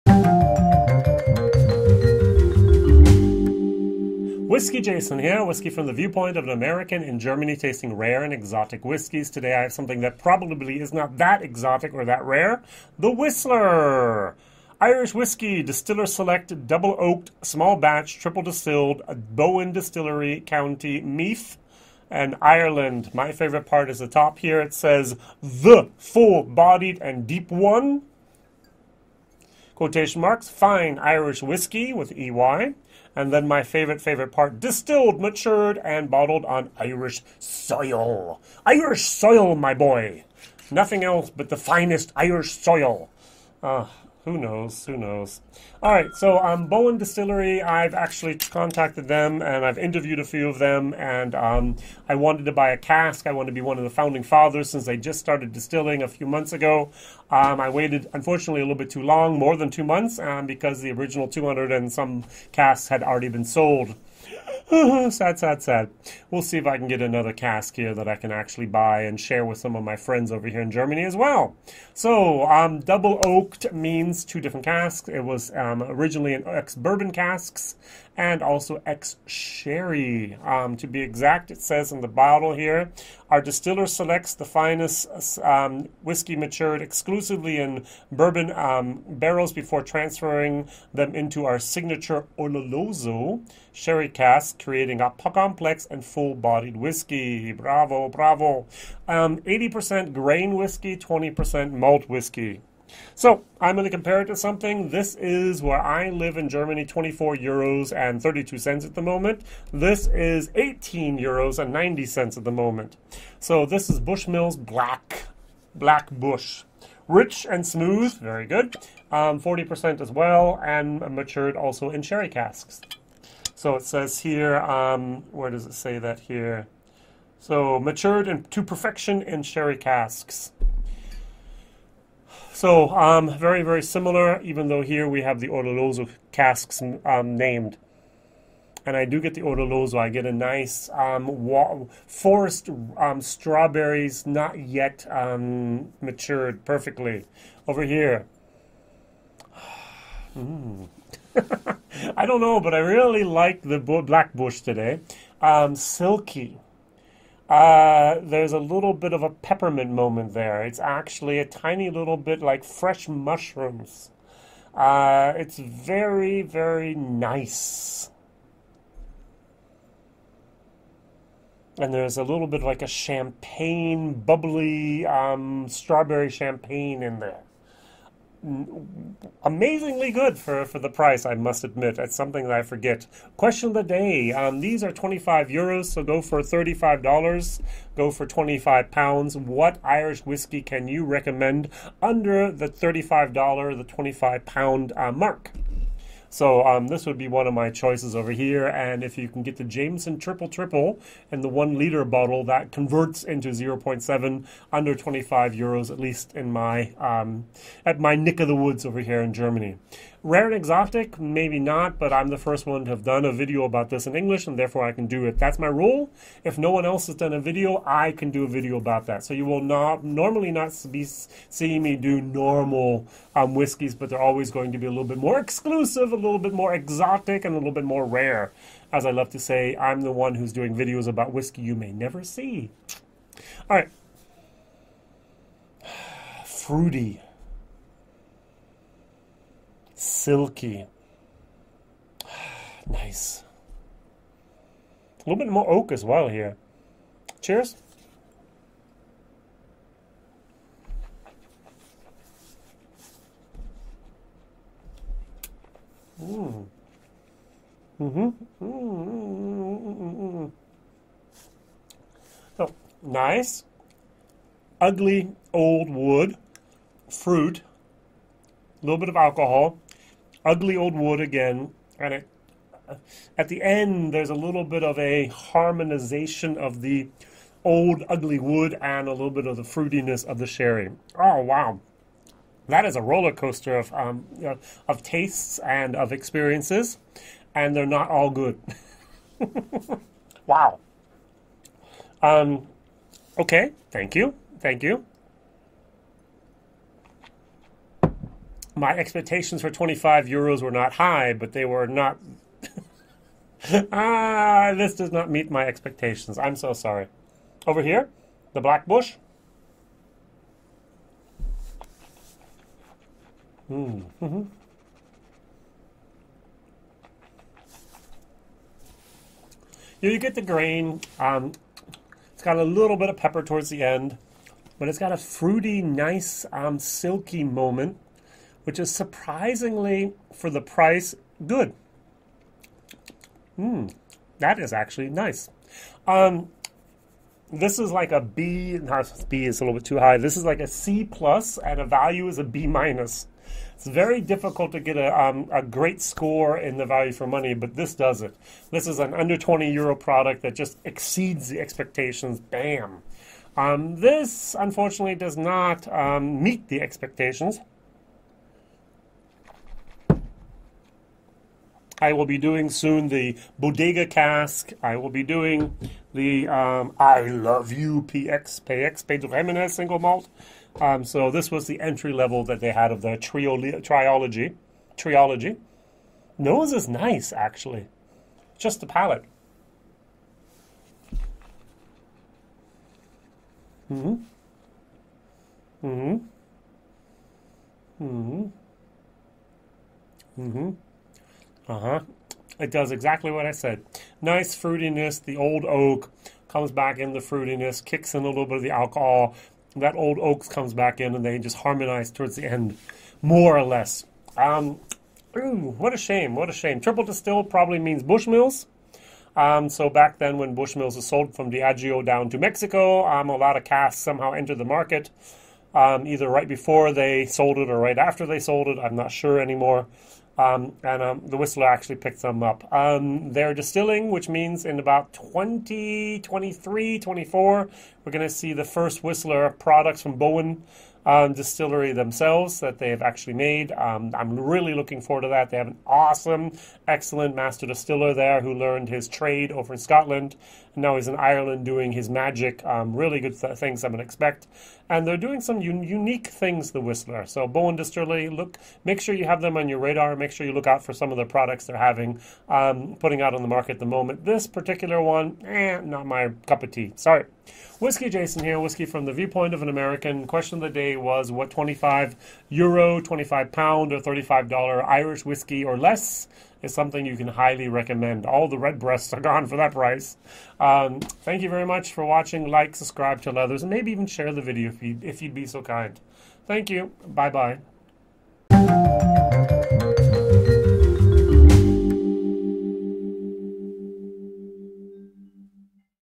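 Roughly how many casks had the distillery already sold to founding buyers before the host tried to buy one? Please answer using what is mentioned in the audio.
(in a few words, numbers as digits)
200 and some.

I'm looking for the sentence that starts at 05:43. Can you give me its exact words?
It's very difficult to get a, um, a great score in the value for money, but this does it.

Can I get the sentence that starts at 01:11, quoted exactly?
So, um, double oaked means two different casks.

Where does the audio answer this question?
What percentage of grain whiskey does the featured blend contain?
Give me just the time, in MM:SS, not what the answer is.
01:39.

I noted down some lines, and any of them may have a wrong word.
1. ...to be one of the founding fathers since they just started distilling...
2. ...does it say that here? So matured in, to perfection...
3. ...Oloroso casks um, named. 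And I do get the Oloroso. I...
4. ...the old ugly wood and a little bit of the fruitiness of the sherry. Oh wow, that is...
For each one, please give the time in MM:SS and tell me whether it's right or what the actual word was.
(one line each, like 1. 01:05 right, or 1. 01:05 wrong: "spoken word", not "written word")
1. 00:53 right
2. 02:05 right
3. 02:15 right
4. 04:36 right.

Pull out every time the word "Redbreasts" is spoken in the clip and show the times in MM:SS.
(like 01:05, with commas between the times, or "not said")
07:48.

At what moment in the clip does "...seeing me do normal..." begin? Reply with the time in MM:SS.
03:41.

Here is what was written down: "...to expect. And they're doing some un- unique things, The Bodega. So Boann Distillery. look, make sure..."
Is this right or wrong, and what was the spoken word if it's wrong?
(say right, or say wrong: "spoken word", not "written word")
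wrong: "Whistler", not "Bodega".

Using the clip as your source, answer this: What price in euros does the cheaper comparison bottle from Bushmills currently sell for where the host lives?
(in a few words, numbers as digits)
18.90 euros.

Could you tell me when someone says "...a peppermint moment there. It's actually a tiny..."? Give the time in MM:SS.
02:39.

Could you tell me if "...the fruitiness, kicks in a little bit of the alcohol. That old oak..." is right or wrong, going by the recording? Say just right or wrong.
right.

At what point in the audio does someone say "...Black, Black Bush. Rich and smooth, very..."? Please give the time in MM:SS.
01:54.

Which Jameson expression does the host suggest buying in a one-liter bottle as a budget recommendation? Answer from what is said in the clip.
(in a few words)
Jameson Triple Triple.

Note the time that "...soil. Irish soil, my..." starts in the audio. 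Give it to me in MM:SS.
00:37.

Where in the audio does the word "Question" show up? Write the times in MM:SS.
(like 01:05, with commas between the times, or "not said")
03:03, 07:40.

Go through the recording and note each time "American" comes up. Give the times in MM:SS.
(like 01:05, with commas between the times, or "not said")
00:06, 07:39.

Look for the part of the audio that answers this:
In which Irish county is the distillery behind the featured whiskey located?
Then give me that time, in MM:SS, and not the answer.
00:20.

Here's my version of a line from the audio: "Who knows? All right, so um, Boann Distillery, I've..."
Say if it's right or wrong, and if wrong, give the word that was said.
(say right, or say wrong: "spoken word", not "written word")
right.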